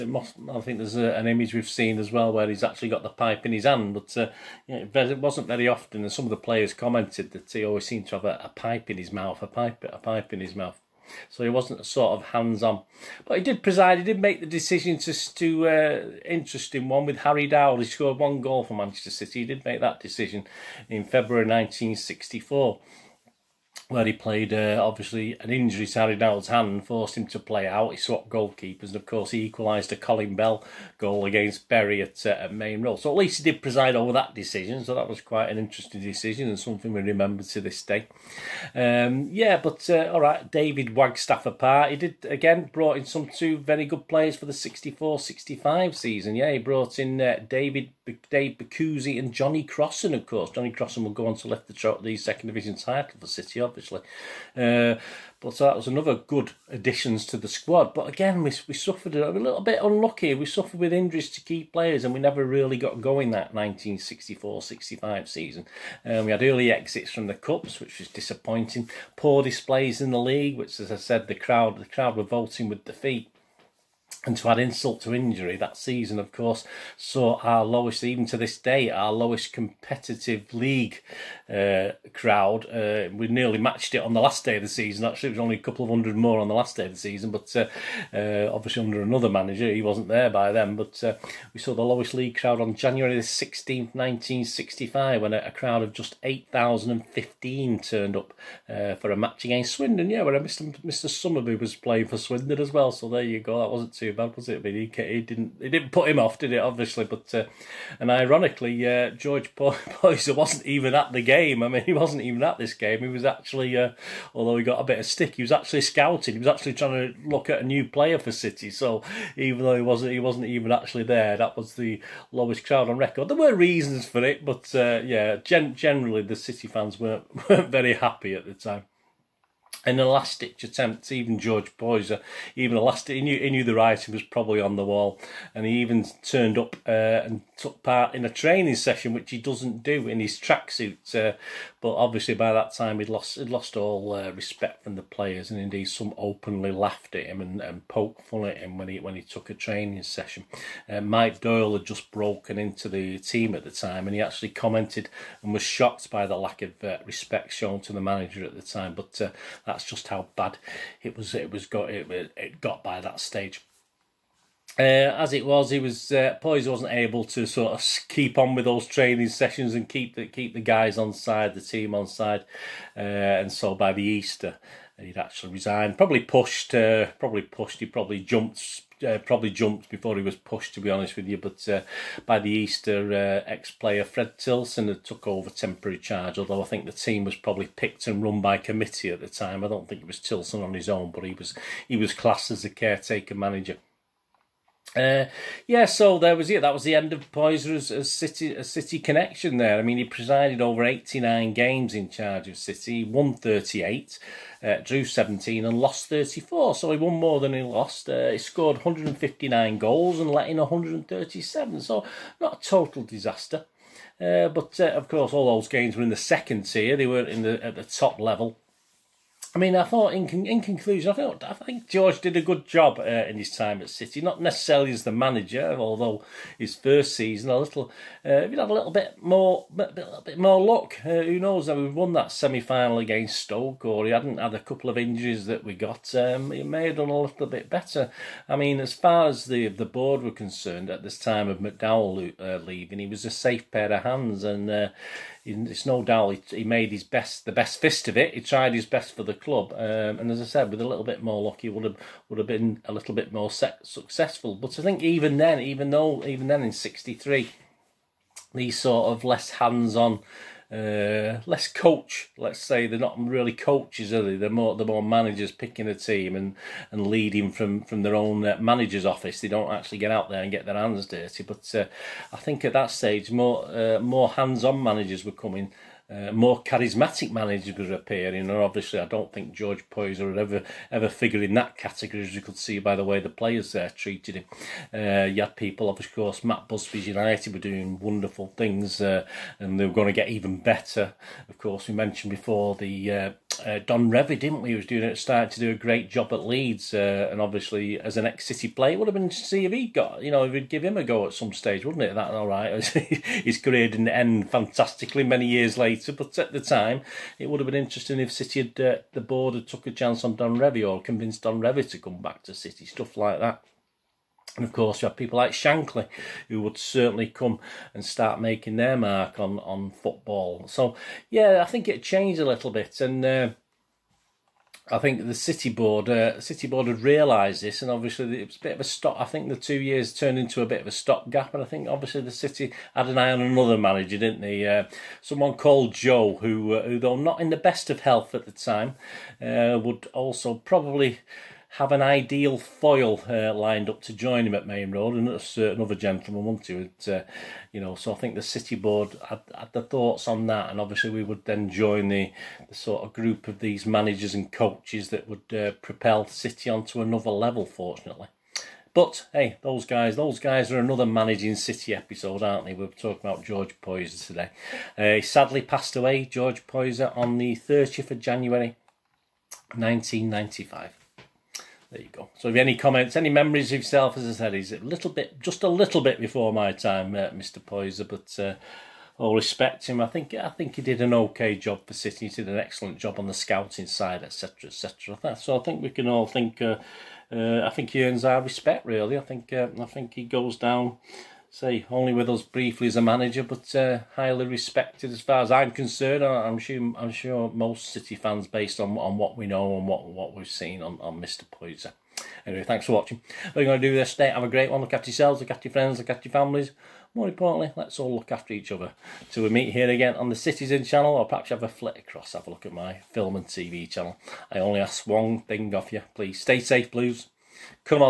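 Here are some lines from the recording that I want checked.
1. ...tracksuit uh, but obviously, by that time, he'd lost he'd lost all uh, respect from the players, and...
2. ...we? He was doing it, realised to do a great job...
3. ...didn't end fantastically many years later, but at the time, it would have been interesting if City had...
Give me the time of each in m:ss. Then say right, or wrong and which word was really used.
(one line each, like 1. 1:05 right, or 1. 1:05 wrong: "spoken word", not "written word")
1. 2:20 right
2. 4:54 wrong: "started", not "realised"
3. 5:03 right.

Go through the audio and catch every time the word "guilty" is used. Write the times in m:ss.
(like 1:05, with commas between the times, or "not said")
not said.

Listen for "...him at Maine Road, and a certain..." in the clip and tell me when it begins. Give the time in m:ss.
5:44.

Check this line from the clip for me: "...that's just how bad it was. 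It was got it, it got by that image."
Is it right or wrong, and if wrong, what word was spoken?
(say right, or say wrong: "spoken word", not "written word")
wrong: "stage", not "image".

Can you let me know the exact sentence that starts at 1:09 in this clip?
Poor displays in the league, which, as I said, the crowd the crowd were voting with defeat.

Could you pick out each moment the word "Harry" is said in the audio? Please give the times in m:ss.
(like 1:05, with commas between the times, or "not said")
0:17, 0:25.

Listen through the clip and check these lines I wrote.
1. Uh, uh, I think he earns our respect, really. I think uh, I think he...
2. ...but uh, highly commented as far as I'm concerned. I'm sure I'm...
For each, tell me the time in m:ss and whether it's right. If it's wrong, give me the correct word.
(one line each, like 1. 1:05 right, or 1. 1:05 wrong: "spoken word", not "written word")
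1. 6:26 right
2. 6:33 wrong: "respected", not "commented".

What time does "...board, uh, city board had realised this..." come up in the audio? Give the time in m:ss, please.
5:25.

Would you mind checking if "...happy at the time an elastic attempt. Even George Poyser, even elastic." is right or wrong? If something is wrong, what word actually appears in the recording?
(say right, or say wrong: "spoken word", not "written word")
right.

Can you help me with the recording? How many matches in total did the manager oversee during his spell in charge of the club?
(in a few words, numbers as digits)
89.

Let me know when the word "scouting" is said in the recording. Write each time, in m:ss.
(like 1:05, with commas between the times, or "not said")
1:55, 6:23.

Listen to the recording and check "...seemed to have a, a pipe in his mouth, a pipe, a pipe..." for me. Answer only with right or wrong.
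right.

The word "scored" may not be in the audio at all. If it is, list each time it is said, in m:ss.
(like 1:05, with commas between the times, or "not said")
0:17, 3:28.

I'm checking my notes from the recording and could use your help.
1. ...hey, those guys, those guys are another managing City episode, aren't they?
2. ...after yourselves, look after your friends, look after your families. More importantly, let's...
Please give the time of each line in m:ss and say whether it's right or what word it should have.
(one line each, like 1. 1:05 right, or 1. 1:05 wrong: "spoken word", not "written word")
1. 5:59 right
2. 6:44 right.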